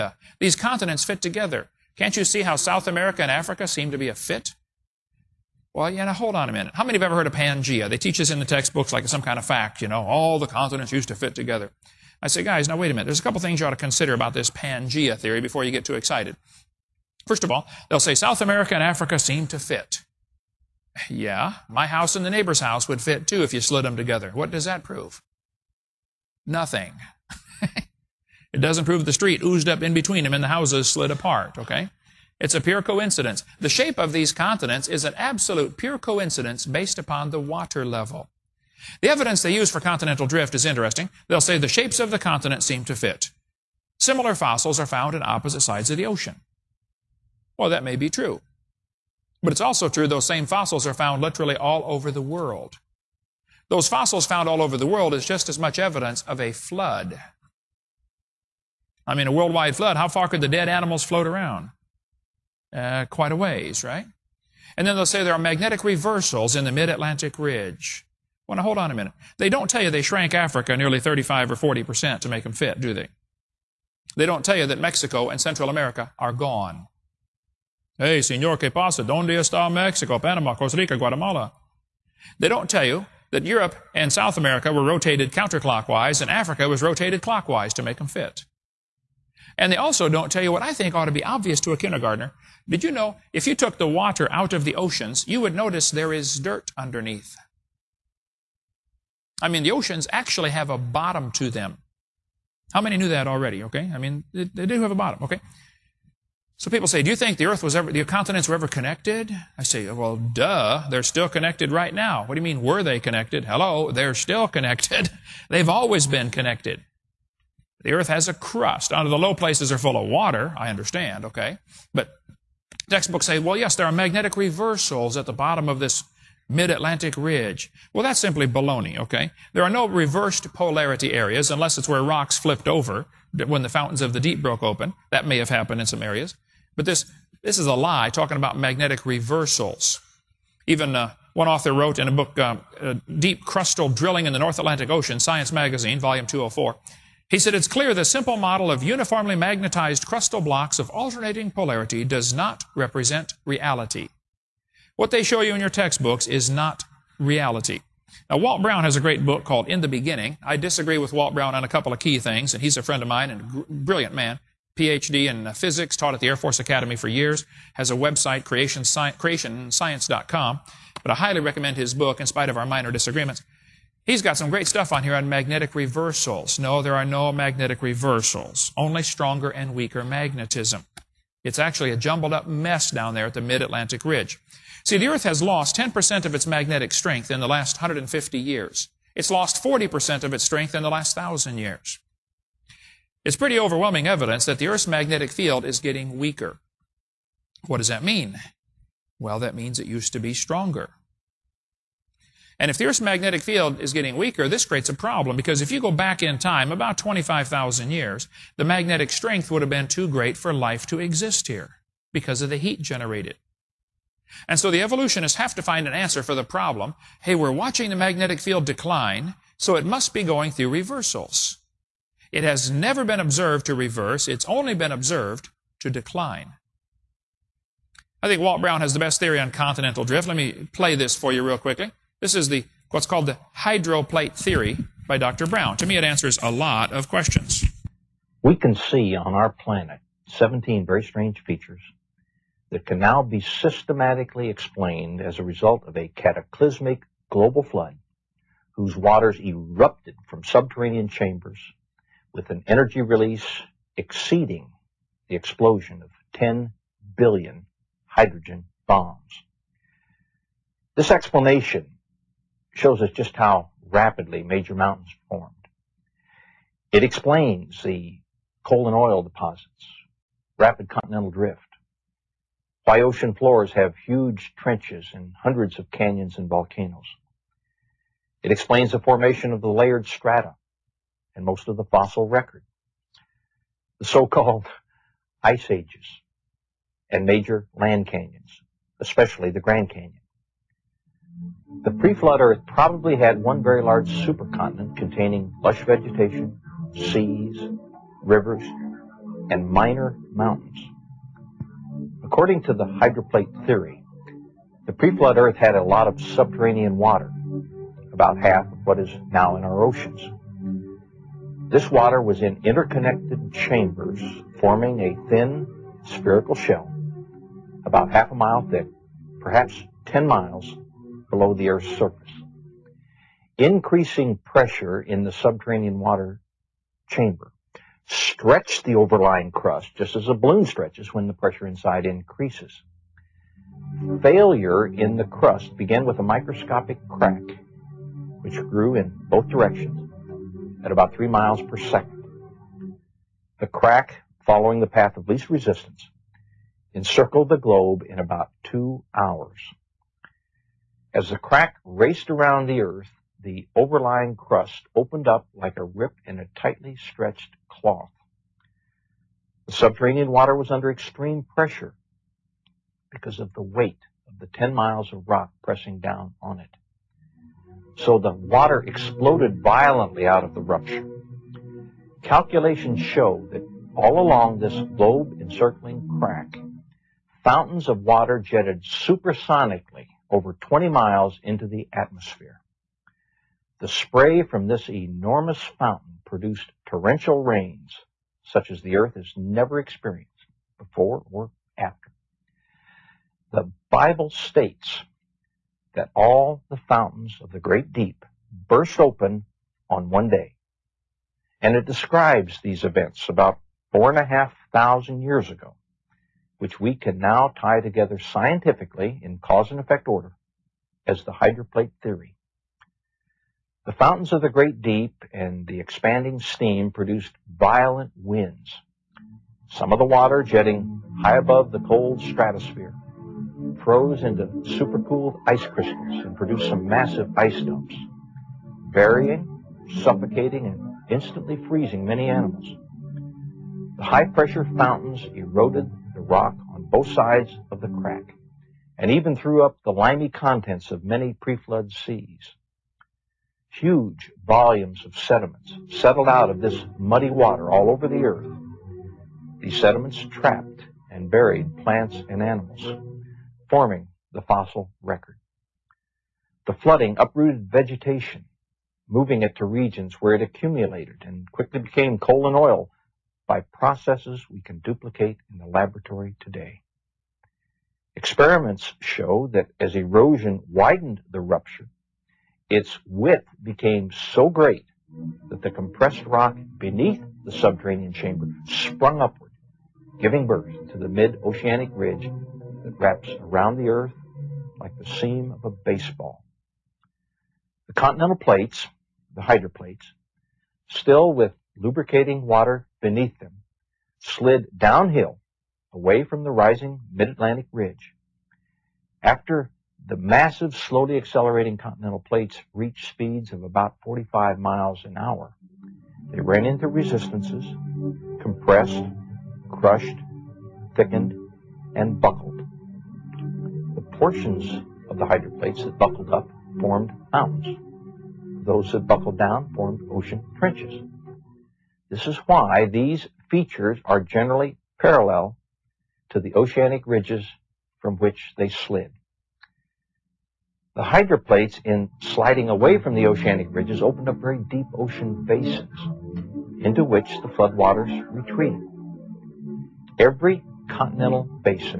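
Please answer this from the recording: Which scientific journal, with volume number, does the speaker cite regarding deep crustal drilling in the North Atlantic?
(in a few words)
Science Magazine, Volume 204.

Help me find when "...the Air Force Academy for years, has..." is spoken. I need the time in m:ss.
2:46.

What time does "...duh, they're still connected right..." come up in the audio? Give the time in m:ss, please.
1:50.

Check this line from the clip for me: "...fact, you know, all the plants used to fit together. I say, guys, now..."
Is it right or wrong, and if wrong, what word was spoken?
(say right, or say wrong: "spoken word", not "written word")
wrong: "continents", not "plants".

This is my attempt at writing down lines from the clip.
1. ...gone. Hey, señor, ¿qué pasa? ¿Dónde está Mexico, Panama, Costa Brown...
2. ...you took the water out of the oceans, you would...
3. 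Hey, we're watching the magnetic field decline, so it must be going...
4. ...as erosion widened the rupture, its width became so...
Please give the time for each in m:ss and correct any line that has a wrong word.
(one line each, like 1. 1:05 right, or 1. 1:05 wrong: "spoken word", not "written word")
1. 1:16 wrong: "Rica", not "Brown"
2. 1:33 right
3. 3:37 right
4. 7:49 right.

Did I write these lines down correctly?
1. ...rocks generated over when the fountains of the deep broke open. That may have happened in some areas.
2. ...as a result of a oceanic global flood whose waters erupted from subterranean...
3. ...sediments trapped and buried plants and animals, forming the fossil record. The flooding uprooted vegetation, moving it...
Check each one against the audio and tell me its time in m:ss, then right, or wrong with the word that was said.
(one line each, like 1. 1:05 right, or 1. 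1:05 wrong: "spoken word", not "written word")
1. 2:12 wrong: "flipped", not "generated"
2. 4:05 wrong: "cataclysmic", not "oceanic"
3. 7:29 right.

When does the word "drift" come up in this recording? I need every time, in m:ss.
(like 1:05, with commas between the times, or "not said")
0:40, 3:50, 4:31.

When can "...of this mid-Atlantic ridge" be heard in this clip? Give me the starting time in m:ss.
2:05.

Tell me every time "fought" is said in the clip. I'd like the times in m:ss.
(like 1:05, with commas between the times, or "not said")
not said.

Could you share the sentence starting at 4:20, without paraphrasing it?
This explanation shows us just how rapidly major mountains formed.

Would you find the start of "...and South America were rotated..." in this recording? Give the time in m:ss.
1:23.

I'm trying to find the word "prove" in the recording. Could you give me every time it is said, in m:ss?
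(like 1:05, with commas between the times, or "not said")
0:24, 0:28.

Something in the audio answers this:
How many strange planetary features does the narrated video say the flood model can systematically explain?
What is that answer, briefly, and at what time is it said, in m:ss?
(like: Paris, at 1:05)
17, at 4:00.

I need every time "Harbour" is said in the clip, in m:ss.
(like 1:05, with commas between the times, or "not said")
not said.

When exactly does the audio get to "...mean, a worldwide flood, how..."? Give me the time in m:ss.
0:59.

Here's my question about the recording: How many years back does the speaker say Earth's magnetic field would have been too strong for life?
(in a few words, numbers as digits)
25,000 years.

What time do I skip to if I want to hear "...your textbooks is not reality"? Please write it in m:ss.
2:35.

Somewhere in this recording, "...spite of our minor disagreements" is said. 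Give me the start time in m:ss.
2:52.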